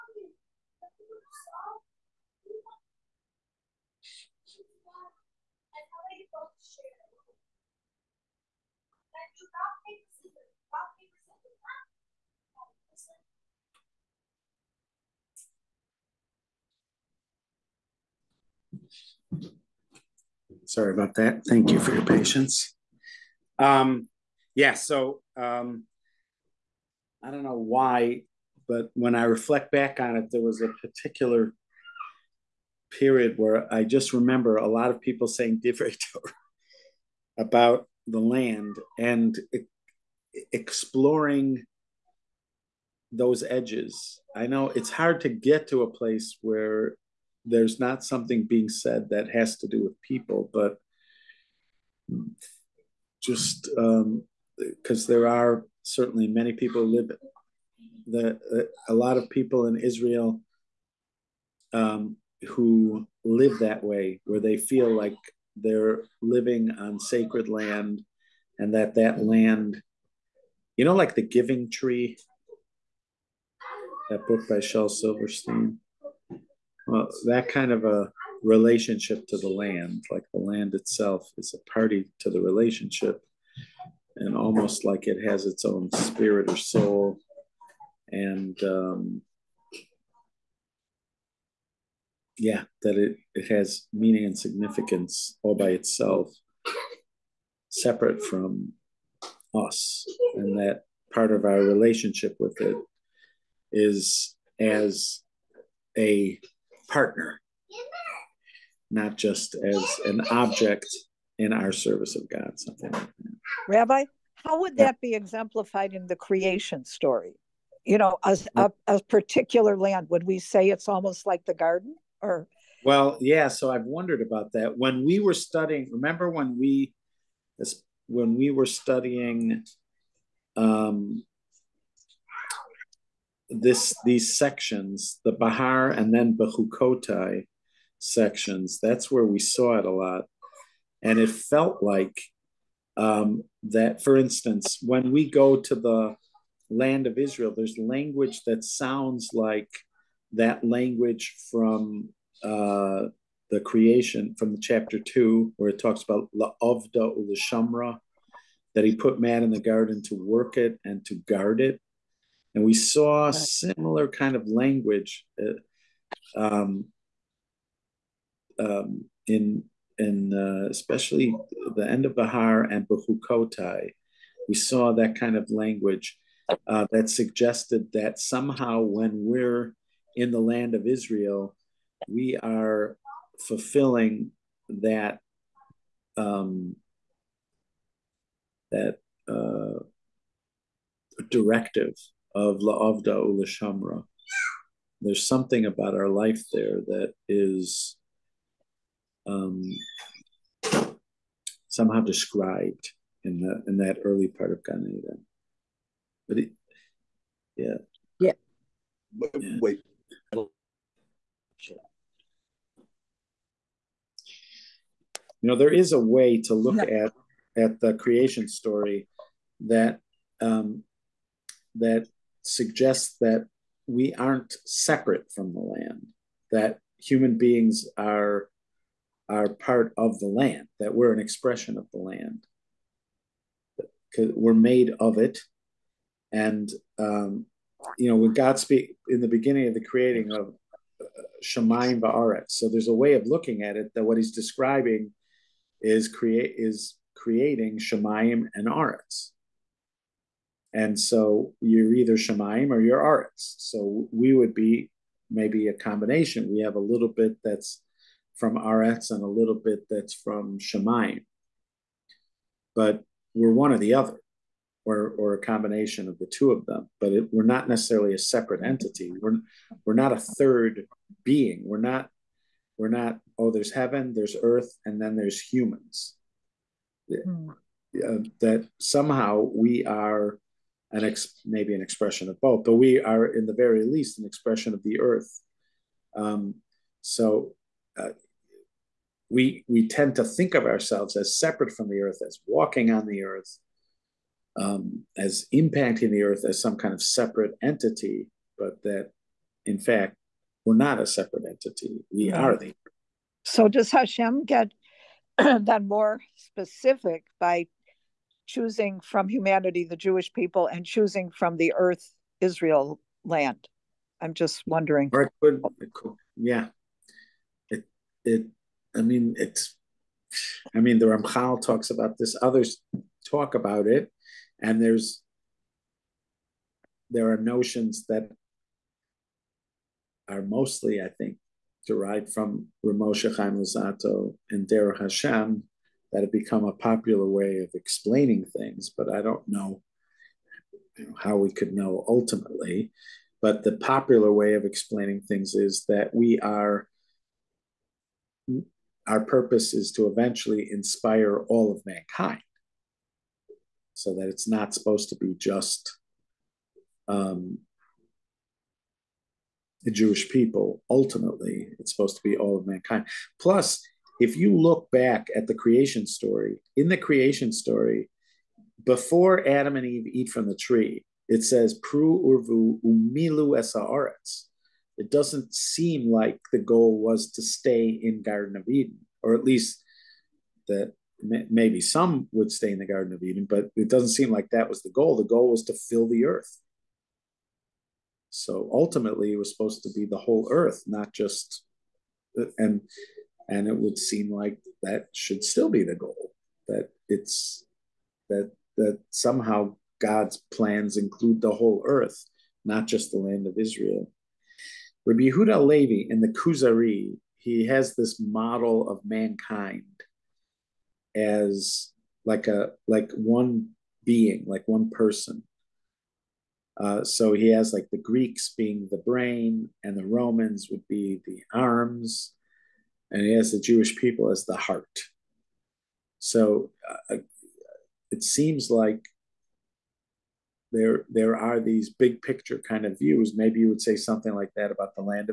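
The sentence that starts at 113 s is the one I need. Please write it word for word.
Rabbi, how would that be exemplified in the creation story?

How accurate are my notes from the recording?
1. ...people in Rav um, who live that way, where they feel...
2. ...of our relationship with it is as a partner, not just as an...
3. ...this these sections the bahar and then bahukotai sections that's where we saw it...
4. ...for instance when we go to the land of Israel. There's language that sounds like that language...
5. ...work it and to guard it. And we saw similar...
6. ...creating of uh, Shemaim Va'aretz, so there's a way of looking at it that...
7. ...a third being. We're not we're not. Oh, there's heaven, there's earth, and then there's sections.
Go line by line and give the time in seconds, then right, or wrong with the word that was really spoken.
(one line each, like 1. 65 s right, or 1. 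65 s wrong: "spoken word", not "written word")
1. 59 s wrong: "Israel", not "Rav"
2. 101 s right
3. 133 s right
4. 144 s right
5. 160 s right
6. 239 s right
7. 270 s wrong: "humans", not "sections".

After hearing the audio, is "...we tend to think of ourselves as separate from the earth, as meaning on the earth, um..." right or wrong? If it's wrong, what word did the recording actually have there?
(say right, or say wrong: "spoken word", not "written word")
wrong: "walking", not "meaning".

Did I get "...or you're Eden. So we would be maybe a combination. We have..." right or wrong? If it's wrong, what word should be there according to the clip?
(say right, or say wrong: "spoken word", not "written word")
wrong: "Aretz", not "Eden".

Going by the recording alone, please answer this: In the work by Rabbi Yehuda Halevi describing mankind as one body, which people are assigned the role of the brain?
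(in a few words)
The Greeks.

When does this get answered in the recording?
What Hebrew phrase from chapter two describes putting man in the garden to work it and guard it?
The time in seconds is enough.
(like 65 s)
156 s.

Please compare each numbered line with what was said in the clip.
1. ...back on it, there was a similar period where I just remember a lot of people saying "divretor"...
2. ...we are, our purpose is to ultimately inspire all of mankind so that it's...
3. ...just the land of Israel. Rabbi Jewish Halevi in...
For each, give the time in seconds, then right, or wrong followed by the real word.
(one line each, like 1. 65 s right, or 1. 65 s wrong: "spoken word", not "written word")
1. 29 s wrong: "particular", not "similar"
2. 346 s wrong: "eventually", not "ultimately"
3. 402 s wrong: "Yehuda", not "Jewish".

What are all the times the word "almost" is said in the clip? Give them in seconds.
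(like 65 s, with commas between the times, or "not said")
84 s, 120 s.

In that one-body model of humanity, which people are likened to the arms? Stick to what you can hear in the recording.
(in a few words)
The Romans.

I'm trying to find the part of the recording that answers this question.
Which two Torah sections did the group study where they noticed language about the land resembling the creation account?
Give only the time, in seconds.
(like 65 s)
172 s.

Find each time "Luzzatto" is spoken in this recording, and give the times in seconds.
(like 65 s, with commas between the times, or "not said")
333 s.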